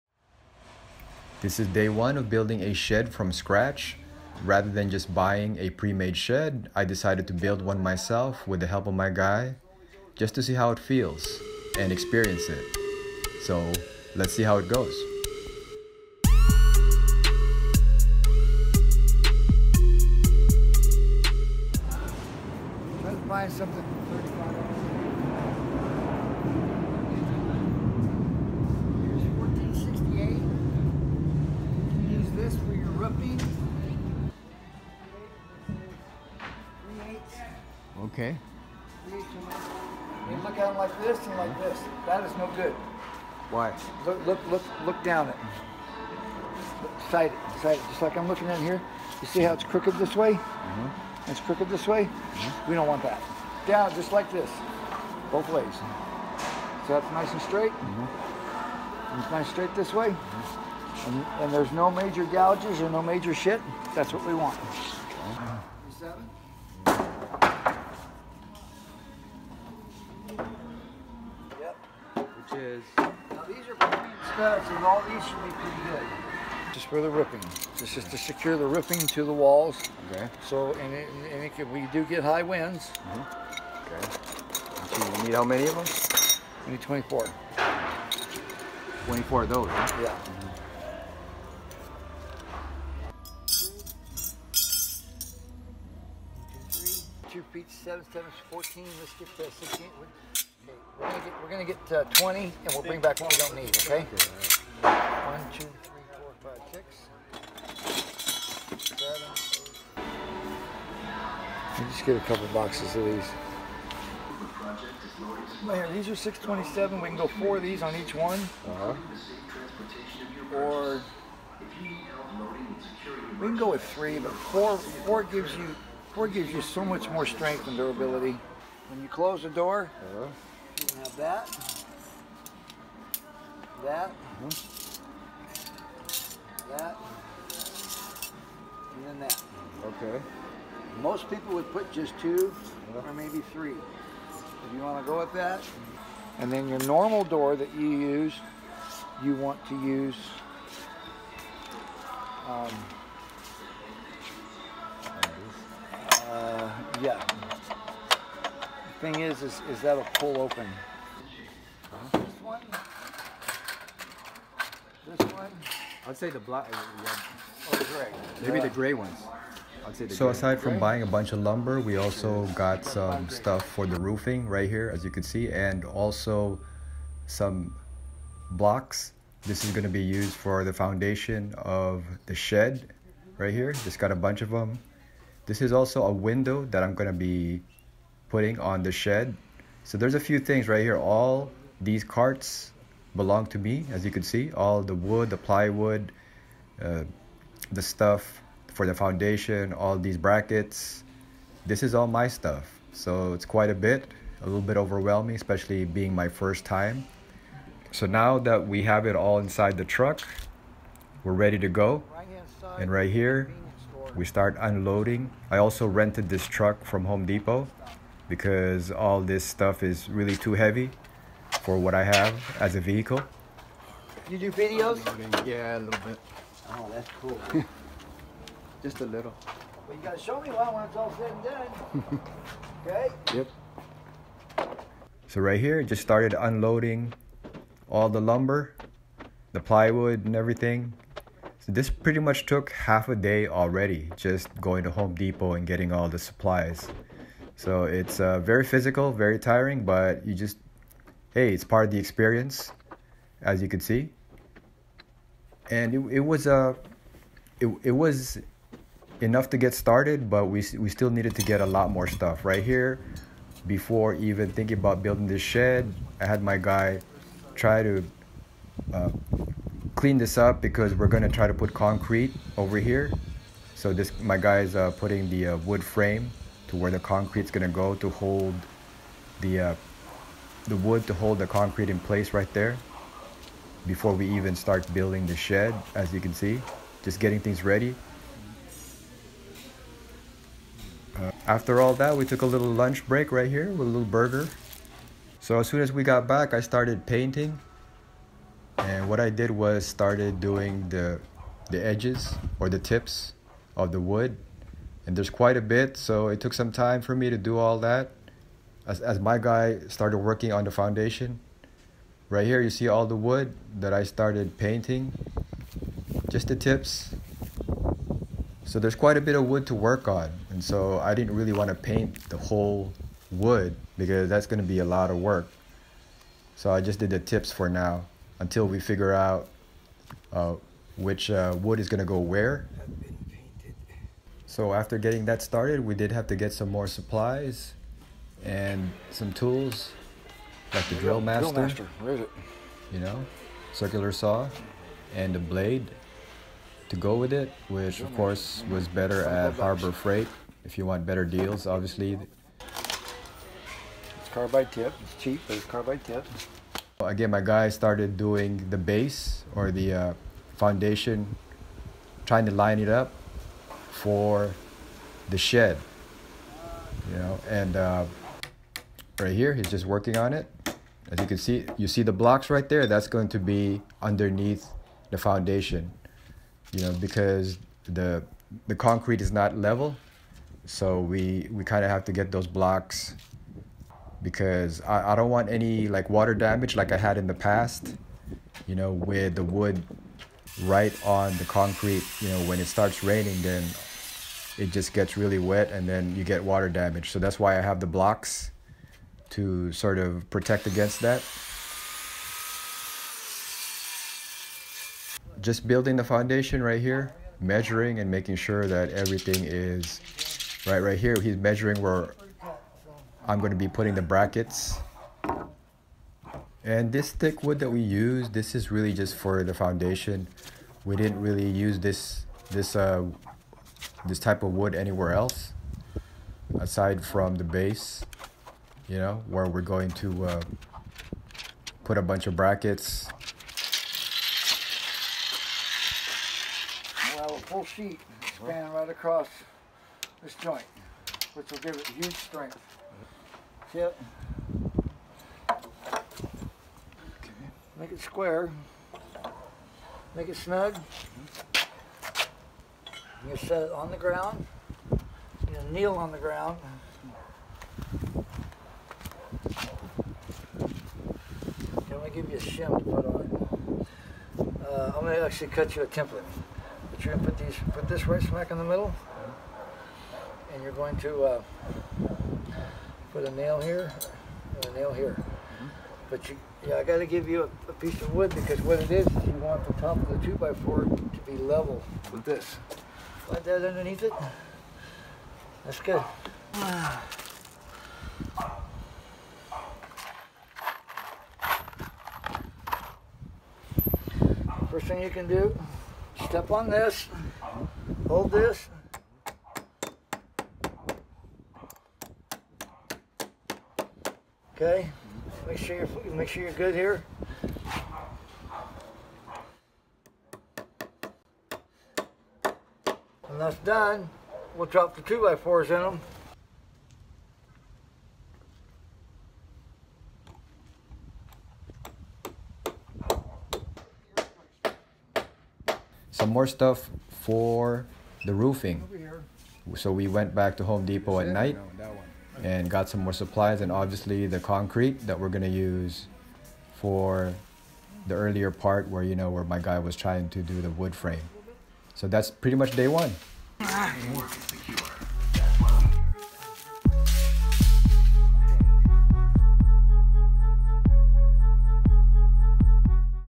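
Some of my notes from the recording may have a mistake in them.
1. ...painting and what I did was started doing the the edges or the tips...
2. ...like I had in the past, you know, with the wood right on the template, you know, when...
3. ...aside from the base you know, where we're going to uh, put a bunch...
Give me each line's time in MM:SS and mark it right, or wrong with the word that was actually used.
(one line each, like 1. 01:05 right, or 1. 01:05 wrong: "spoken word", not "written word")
1. 04:57 right
2. 06:26 wrong: "concrete", not "template"
3. 07:06 right.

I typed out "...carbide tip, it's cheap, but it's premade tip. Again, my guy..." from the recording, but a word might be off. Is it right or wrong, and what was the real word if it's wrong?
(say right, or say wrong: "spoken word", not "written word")
wrong: "carbide", not "premade".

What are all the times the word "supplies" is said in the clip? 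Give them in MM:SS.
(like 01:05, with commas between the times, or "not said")
04:06, 05:36, 08:53.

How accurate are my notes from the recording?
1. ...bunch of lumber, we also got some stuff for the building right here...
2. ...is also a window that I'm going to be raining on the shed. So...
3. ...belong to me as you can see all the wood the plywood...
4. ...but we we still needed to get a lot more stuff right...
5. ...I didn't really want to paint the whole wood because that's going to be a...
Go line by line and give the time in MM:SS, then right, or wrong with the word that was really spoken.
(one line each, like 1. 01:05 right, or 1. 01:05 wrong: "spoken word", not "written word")
1. 02:51 wrong: "roofing", not "building"
2. 03:05 wrong: "putting", not "raining"
3. 03:13 right
4. 04:20 right
5. 05:20 right.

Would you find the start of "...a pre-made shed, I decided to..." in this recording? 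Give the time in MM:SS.
00:05.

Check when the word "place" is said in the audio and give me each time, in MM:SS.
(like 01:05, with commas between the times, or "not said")
04:41.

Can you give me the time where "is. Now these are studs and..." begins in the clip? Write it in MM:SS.
01:12.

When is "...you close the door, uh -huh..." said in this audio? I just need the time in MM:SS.
02:09.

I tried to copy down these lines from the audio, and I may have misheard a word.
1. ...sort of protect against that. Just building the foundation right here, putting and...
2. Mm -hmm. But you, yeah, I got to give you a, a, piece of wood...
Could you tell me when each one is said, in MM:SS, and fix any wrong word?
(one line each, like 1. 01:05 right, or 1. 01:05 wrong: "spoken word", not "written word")
1. 06:39 wrong: "measuring", not "putting"
2. 07:55 right.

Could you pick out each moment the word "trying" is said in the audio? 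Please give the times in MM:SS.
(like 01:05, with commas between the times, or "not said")
06:02, 08:59.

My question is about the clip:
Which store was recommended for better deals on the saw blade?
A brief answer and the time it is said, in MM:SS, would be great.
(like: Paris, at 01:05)
Harbor Freight, at 05:49.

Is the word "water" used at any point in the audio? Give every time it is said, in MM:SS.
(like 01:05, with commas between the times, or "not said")
06:26, 06:36.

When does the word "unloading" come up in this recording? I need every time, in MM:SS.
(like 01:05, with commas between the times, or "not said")
03:34, 03:56.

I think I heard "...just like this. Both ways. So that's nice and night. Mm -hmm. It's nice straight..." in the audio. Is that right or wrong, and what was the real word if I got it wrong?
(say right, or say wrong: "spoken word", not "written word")
wrong: "straight", not "night".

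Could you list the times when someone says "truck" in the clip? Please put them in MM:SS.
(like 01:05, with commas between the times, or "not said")
03:29, 03:36.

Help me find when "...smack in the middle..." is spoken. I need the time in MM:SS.
07:48.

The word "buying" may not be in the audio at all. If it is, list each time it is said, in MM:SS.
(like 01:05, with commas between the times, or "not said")
00:05, 02:50.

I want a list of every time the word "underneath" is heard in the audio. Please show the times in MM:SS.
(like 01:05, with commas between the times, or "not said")
06:14, 08:03.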